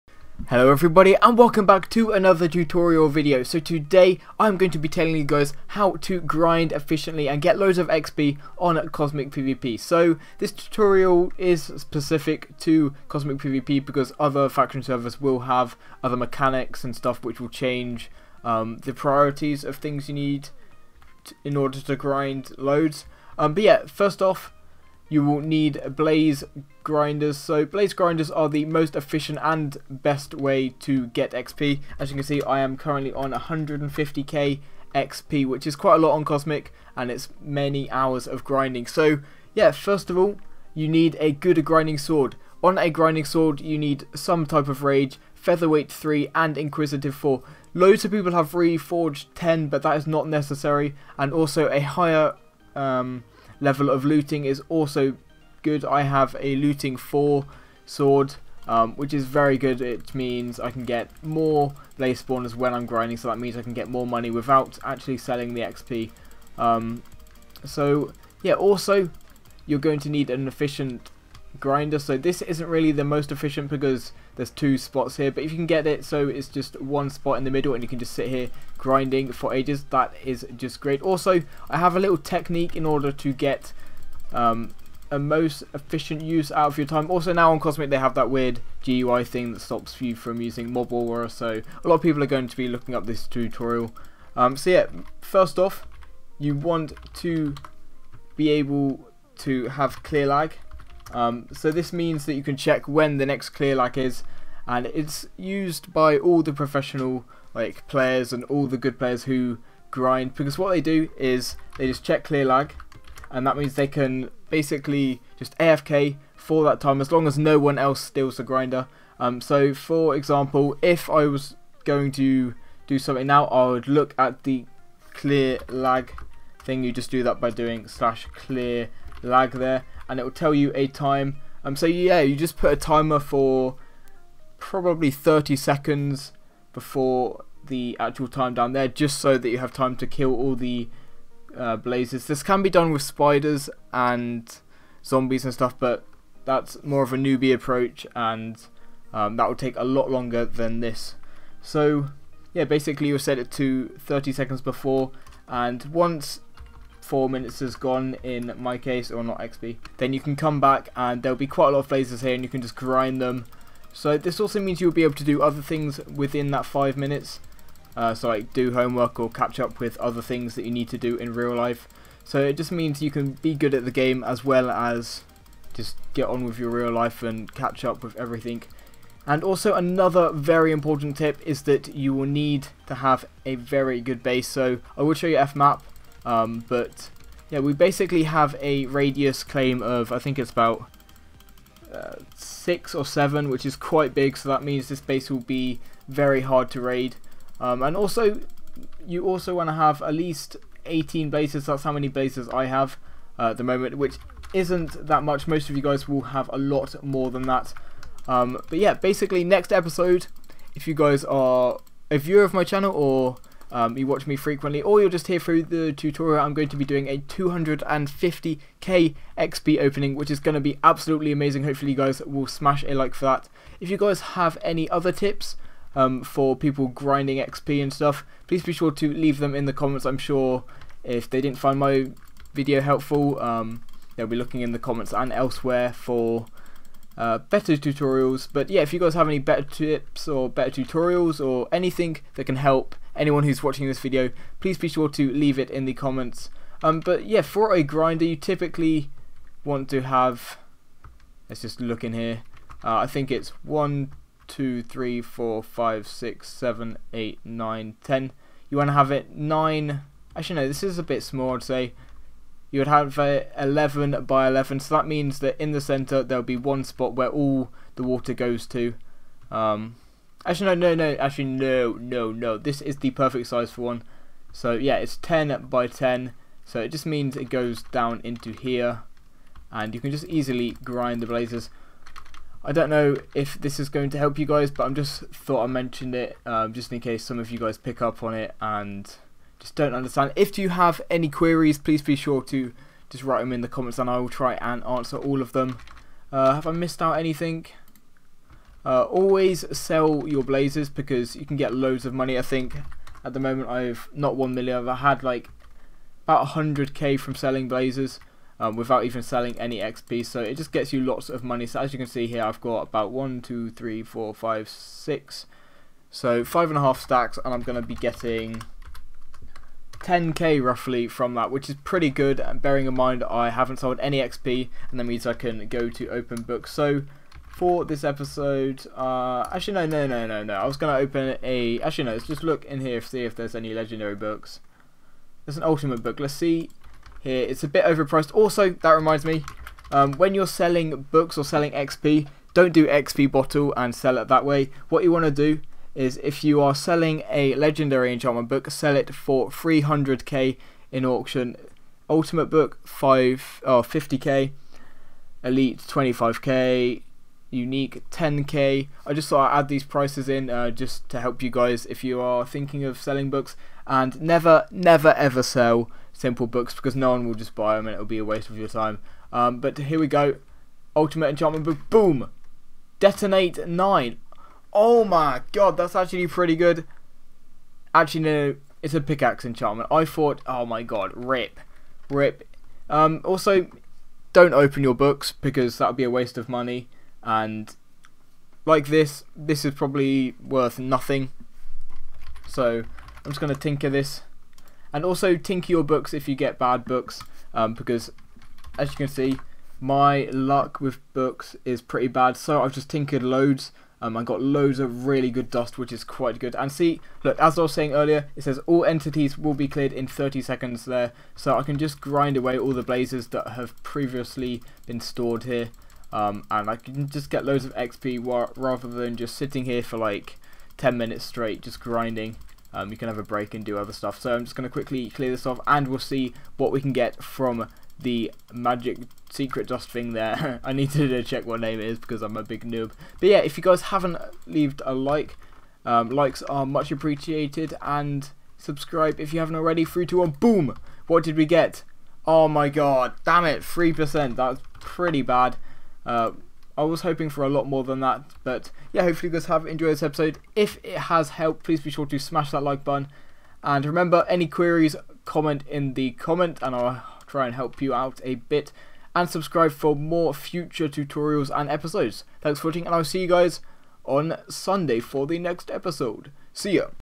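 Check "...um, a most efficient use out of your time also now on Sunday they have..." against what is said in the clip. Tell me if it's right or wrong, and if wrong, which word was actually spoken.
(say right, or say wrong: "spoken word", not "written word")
wrong: "Cosmic", not "Sunday".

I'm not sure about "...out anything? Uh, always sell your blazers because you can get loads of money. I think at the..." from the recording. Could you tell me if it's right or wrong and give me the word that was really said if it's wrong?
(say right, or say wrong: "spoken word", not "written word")
right.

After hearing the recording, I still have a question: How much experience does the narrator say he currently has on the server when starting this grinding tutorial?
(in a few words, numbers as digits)
150k XP.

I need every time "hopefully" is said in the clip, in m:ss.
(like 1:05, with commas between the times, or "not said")
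3:41, 7:29.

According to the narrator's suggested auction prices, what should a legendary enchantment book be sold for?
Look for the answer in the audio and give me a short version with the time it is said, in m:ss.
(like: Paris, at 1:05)
300k, at 5:49.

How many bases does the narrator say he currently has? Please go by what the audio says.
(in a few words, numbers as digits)
18.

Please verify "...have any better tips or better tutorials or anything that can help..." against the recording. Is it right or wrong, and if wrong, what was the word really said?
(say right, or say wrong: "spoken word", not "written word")
right.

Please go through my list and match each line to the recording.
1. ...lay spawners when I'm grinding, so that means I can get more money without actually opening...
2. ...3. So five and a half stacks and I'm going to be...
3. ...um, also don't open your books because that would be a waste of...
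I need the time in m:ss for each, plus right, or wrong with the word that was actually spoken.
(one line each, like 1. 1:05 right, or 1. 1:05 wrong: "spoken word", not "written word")
1. 1:01 wrong: "selling", not "opening"
2. 5:14 wrong: "6", not "3"
3. 6:22 right.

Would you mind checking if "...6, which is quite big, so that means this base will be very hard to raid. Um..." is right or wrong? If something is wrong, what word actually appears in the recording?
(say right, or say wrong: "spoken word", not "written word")
wrong: "7", not "6".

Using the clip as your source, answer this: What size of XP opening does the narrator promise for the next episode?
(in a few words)
250k.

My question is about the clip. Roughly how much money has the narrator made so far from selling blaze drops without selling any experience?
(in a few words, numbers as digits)
100k.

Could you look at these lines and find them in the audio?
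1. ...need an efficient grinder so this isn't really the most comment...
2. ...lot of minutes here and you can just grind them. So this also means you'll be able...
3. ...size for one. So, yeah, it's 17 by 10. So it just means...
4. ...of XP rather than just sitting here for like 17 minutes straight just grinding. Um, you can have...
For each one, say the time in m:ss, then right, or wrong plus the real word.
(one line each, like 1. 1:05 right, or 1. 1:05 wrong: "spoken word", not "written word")
1. 1:10 wrong: "efficient", not "comment"
2. 2:41 wrong: "blazes", not "minutes"
3. 4:33 wrong: "10", not "17"
4. 6:57 wrong: "10", not "17".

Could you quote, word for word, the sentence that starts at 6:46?
And see, look, as I was saying earlier, it says all entities will be cleared in 30 seconds there.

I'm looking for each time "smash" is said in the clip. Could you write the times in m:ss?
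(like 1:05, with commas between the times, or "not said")
3:42, 7:32.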